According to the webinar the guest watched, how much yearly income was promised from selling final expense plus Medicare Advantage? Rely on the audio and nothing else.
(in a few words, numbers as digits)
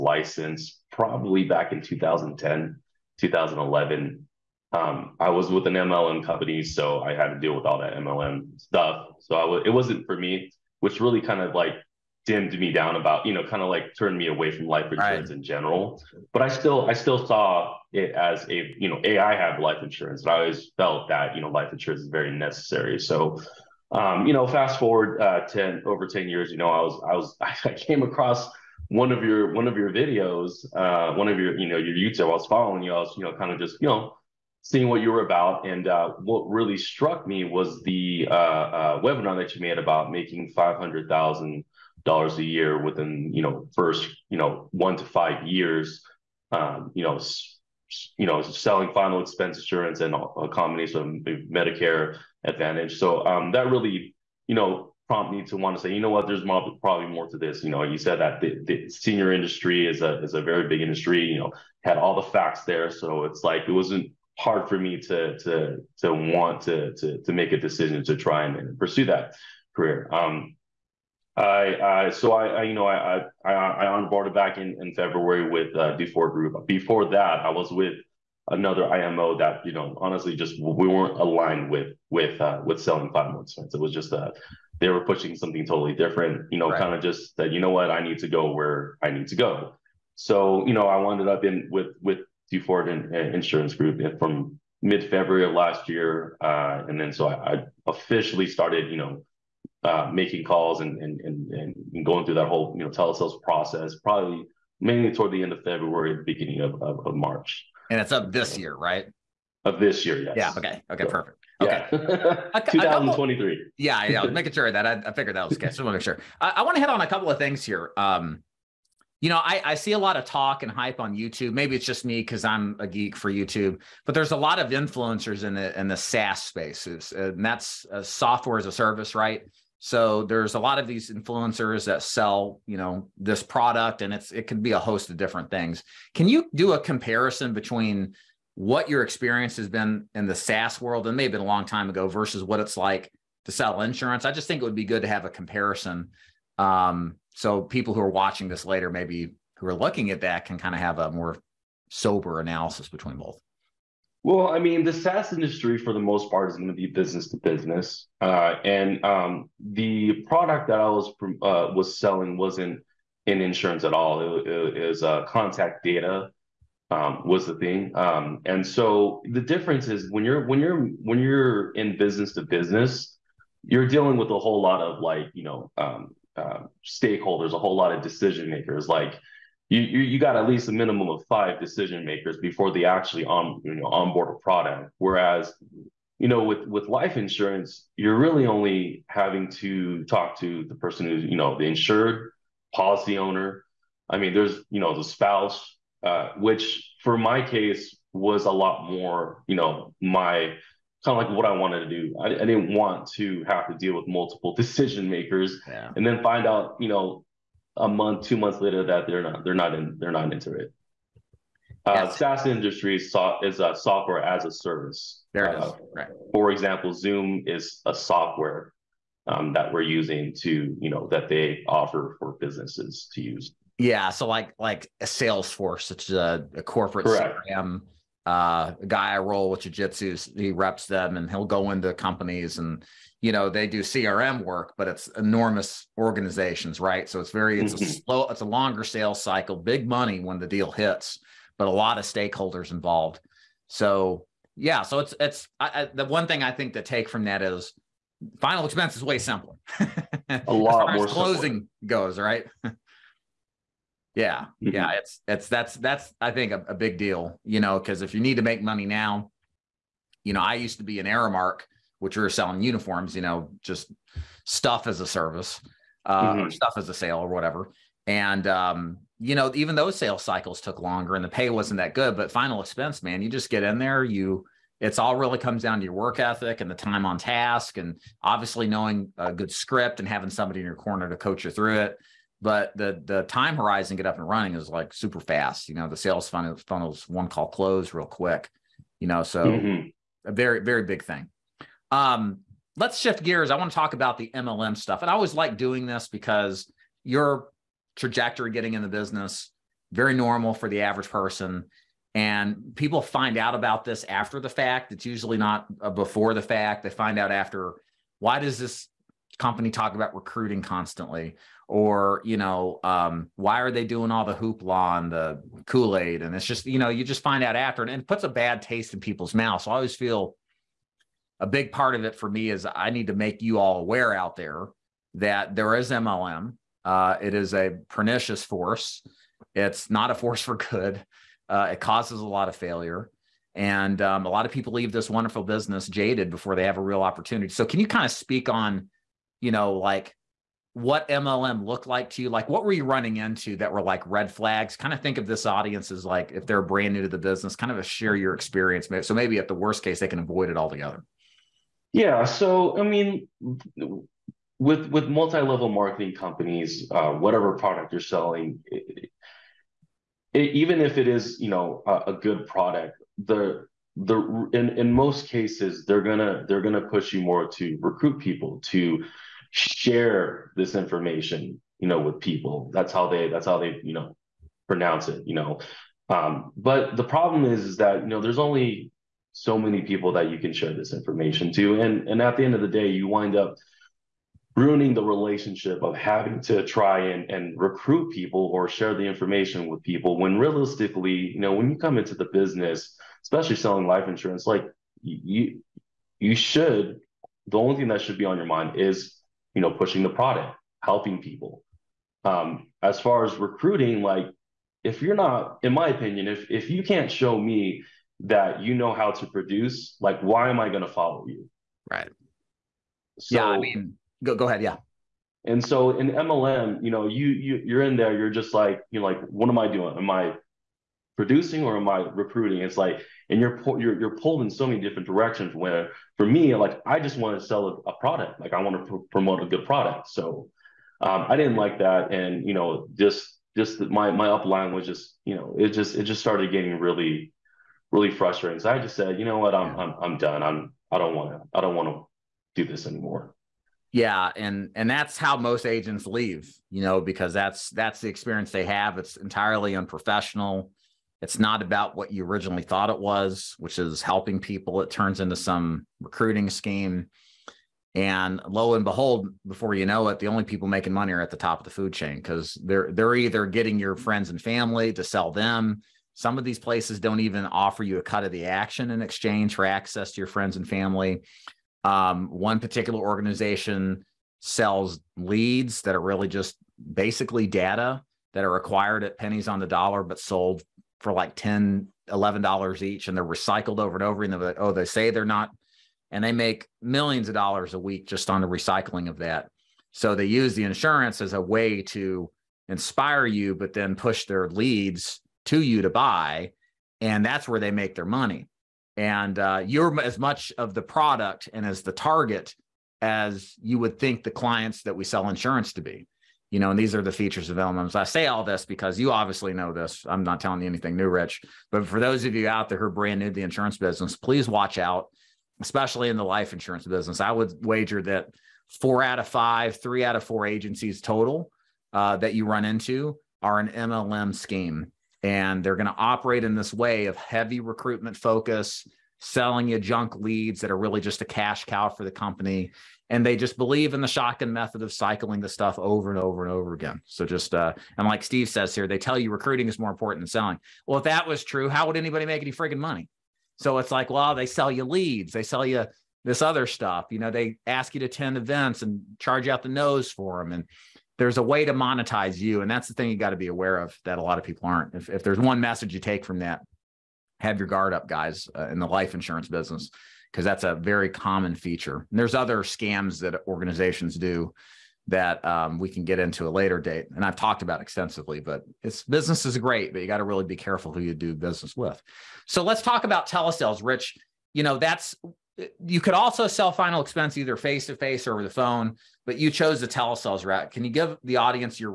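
$500,000.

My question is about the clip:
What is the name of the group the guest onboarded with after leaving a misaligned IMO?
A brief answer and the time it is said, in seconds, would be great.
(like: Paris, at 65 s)
Duford Group, at 75 s.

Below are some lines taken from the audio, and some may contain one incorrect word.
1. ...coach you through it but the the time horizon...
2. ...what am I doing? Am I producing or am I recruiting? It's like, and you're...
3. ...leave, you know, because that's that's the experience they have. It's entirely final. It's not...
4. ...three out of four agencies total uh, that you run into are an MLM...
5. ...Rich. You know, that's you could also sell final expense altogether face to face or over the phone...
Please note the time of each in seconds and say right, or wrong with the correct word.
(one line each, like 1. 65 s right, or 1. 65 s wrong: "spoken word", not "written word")
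1. 281 s right
2. 419 s right
3. 446 s wrong: "unprofessional", not "final"
4. 519 s right
5. 573 s wrong: "either", not "altogether".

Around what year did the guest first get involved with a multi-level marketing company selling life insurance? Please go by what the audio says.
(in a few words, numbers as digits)
2010.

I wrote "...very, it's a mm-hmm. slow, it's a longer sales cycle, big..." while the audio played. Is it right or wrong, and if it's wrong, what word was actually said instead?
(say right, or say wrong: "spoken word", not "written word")
right.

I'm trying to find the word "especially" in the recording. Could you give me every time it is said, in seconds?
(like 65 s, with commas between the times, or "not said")
393 s, 515 s.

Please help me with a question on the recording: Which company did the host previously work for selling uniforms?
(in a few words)
Aramark.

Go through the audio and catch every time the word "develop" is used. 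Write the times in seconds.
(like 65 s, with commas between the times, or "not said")
not said.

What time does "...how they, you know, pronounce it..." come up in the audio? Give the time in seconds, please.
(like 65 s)
373 s.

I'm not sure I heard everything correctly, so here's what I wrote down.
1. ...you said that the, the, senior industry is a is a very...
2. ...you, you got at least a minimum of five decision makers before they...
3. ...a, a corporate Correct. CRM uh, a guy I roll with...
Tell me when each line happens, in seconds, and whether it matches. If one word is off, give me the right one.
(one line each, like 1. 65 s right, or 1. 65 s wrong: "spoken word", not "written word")
1. 57 s right
2. 179 s right
3. 226 s right.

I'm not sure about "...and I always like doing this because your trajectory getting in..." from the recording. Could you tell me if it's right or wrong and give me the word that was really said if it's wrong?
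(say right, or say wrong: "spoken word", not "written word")
right.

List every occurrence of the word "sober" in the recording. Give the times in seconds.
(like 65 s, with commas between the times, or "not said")
151 s.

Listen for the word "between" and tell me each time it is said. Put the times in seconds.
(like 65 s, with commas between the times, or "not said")
137 s, 152 s.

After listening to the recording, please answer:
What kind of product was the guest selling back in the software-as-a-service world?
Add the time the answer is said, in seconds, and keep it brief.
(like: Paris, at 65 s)
Contact data, at 165 s.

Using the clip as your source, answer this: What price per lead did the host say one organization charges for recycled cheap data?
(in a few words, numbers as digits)
$10-11.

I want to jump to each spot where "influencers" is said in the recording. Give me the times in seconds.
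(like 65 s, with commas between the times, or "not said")
124 s, 131 s.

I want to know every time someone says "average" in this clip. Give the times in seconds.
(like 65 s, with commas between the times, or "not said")
300 s.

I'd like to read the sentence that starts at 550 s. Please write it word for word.
And there's a way to monetize you.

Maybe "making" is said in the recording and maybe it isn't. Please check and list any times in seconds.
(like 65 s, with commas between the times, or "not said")
40 s, 100 s, 114 s, 460 s.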